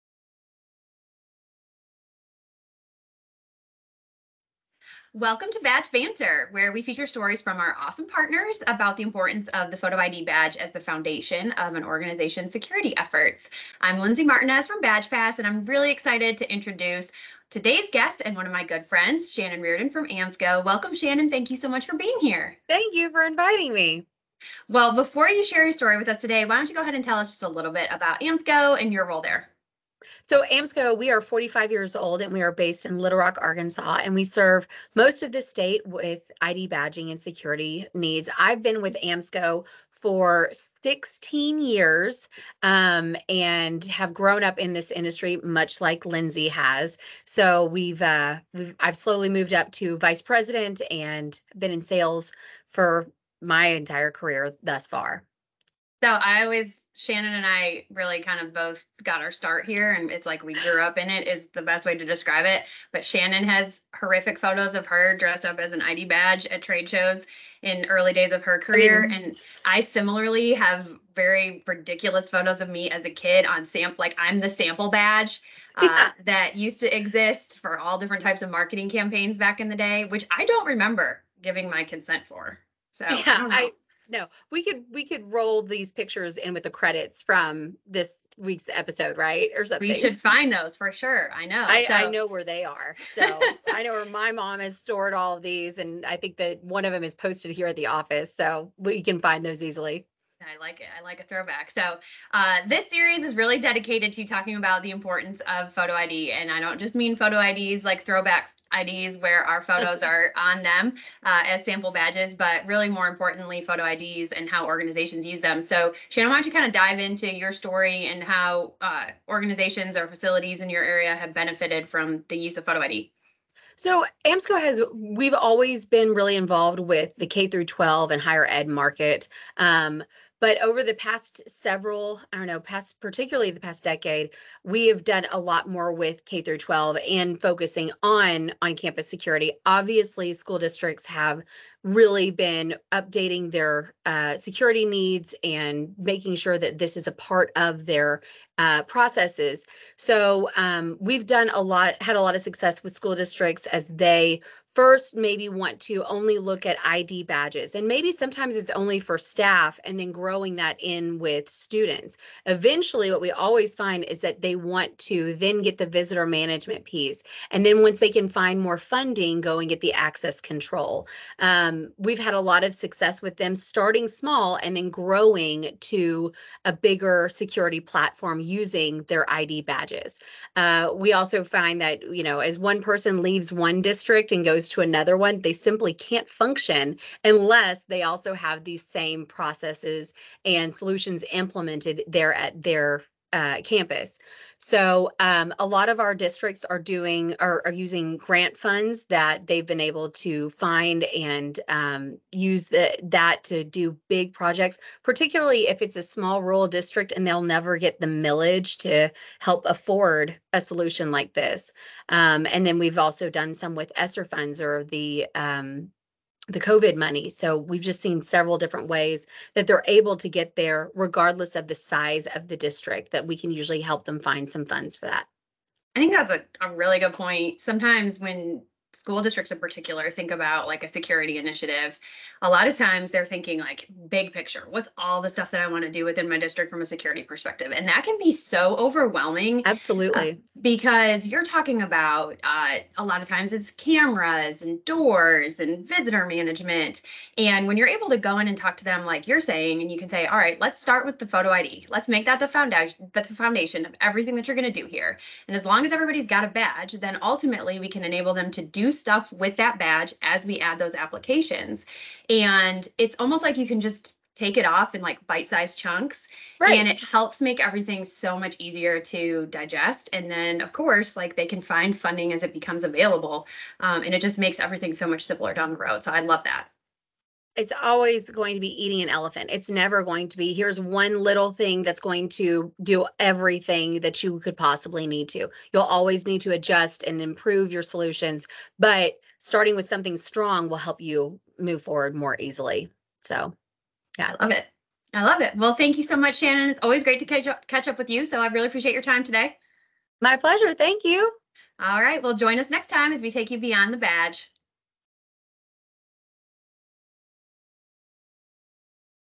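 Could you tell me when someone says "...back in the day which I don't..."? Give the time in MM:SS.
01:19.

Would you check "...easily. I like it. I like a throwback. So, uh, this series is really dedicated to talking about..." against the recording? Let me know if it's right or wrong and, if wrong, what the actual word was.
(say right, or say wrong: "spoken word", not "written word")
right.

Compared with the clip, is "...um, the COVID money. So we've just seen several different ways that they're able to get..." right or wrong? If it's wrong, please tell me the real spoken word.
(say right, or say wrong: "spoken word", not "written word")
right.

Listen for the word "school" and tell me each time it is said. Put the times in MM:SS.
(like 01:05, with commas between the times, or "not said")
02:20, 02:32, 03:49.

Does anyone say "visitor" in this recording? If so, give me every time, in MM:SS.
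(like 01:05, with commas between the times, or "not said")
02:45, 04:05.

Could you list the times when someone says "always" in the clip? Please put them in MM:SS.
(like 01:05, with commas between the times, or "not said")
00:56, 02:05, 02:43, 04:37, 04:45, 04:56.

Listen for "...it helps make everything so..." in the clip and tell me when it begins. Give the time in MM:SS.
04:26.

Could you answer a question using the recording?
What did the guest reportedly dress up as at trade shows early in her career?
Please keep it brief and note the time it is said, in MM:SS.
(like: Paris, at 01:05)
an ID badge, at 01:05.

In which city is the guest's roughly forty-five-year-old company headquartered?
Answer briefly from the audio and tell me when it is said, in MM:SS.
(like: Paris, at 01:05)
Little Rock, at 00:32.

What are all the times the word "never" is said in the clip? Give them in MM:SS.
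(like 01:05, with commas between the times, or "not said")
03:27, 04:39.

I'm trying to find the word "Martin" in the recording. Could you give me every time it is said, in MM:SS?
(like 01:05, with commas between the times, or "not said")
00:14.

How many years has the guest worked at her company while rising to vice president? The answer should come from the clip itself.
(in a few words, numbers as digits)
16.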